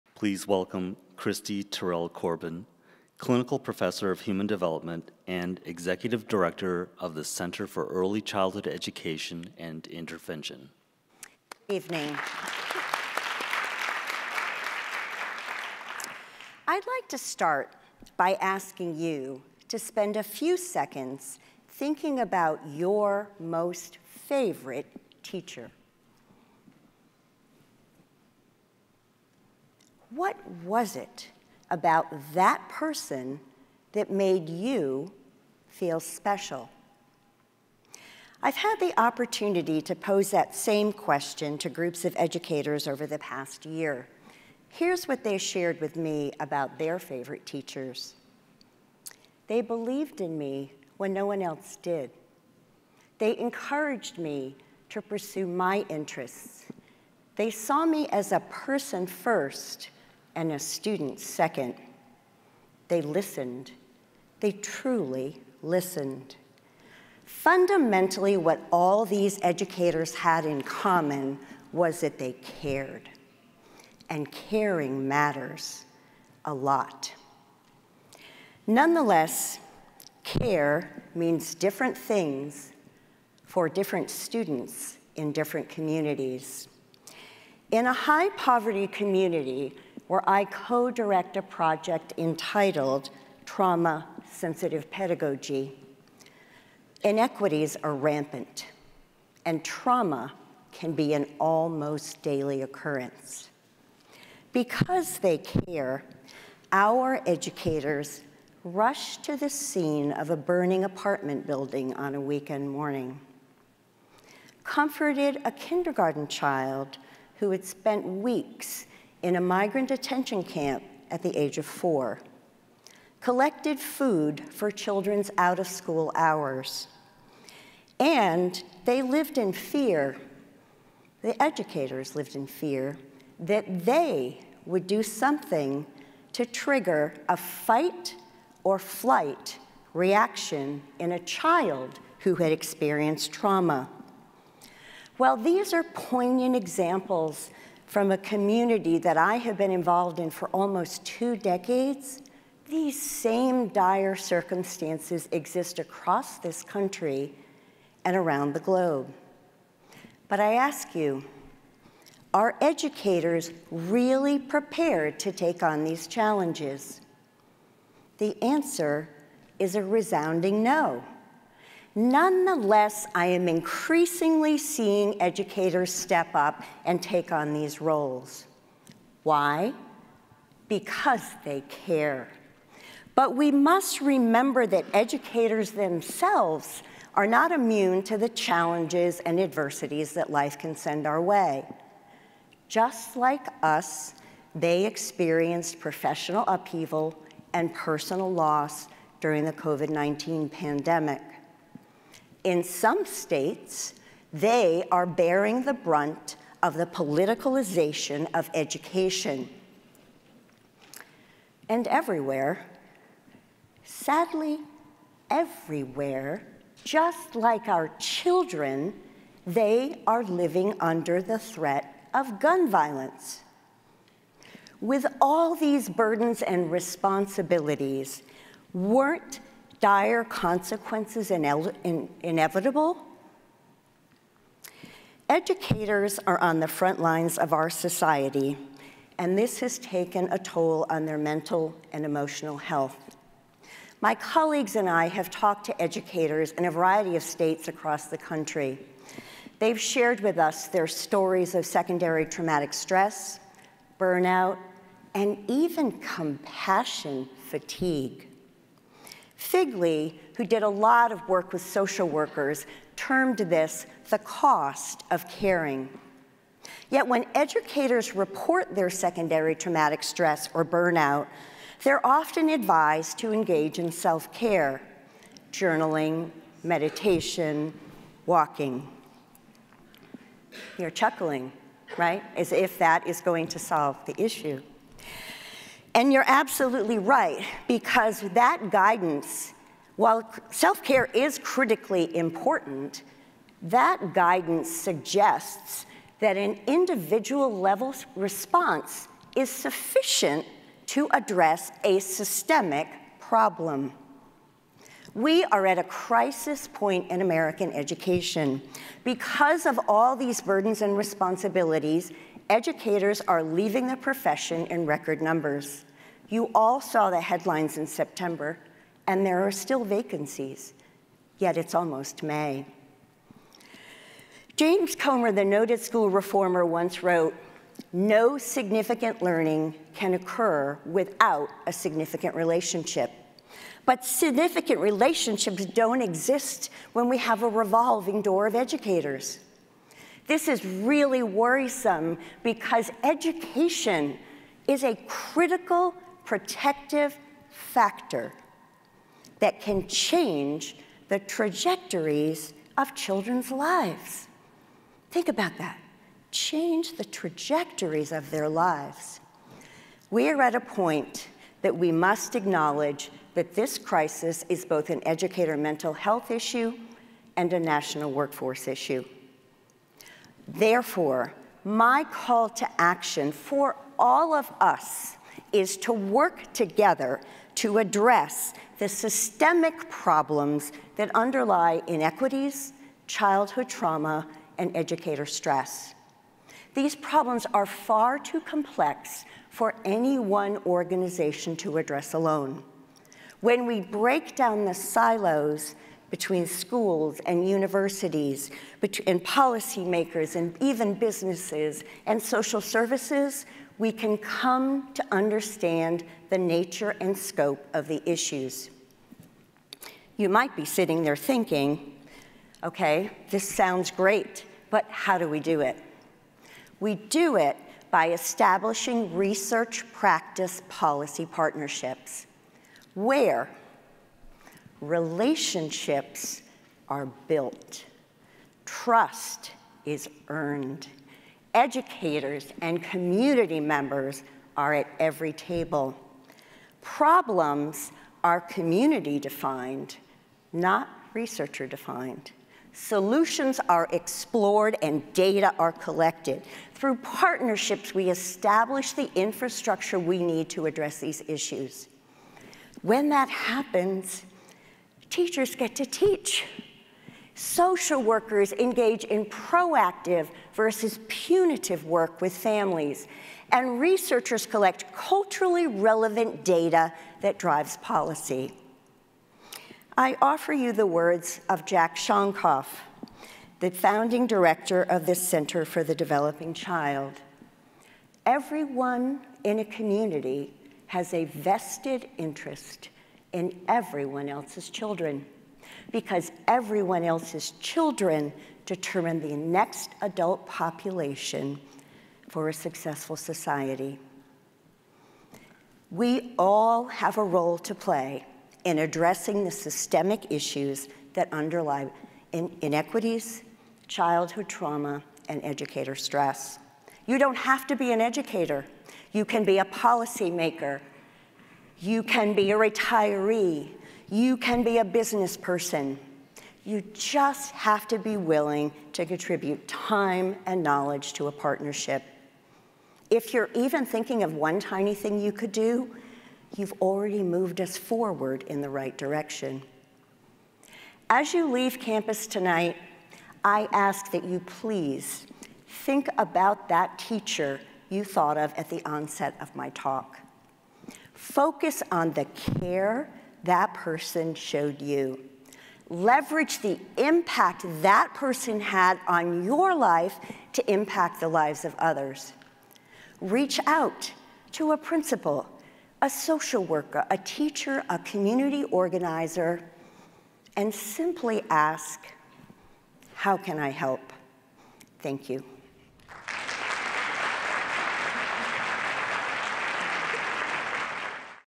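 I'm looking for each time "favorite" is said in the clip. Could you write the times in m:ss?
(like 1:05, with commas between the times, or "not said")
0:24, 0:46.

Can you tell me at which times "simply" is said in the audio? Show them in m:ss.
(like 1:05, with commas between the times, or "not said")
9:20.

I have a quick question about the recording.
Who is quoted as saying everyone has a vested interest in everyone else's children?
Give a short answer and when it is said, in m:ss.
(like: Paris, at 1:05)
Jack Shonkoff, at 7:51.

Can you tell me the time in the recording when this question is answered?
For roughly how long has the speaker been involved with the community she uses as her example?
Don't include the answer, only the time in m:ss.
2:30.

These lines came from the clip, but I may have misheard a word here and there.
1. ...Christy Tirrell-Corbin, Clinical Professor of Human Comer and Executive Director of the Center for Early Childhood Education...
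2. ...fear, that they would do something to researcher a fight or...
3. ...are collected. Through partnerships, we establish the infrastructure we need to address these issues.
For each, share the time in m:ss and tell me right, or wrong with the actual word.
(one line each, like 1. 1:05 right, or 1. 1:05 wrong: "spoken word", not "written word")
1. 0:01 wrong: "Development", not "Comer"
2. 2:12 wrong: "trigger", not "researcher"
3. 7:25 right.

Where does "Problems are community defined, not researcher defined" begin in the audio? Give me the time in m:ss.
7:16.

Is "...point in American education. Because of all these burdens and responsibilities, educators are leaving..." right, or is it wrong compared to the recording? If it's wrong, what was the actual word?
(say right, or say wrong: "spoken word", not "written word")
right.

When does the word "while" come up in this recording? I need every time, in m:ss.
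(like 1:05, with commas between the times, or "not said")
2:25, 4:49.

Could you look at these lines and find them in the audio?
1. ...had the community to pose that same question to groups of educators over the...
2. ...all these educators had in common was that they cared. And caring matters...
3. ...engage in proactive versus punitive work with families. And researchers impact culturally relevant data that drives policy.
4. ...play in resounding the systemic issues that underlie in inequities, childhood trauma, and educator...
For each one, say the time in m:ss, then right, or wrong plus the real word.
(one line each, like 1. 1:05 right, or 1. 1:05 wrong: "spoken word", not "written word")
1. 0:38 wrong: "opportunity", not "community"
2. 1:08 right
3. 7:38 wrong: "collect", not "impact"
4. 8:17 wrong: "addressing", not "resounding".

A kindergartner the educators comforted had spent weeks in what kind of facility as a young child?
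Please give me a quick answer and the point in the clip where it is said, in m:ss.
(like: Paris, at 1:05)
migrant detention camp, at 1:59.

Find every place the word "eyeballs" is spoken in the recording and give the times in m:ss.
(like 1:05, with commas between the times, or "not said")
not said.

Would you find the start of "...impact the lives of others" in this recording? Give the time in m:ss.
9:10.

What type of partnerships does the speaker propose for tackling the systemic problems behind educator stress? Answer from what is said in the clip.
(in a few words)
research practice policy partnerships.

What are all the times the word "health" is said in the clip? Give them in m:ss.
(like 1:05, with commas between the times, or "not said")
4:02, 6:05.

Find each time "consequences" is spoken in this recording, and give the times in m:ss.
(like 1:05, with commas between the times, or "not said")
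3:50.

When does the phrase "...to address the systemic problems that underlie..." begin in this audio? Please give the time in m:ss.
6:17.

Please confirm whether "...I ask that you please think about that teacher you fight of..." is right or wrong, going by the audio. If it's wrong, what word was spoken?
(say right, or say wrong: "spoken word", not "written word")
wrong: "thought", not "fight".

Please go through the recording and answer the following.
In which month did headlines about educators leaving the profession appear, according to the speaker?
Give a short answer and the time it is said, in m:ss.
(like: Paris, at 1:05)
September, at 5:17.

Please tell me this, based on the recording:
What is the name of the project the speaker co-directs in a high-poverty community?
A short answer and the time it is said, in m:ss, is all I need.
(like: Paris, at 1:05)
Trauma-Sensitive Pedagogy, at 1:33.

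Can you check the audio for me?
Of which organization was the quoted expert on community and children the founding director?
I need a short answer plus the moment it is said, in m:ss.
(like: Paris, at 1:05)
Center for the Developing Child, at 7:55.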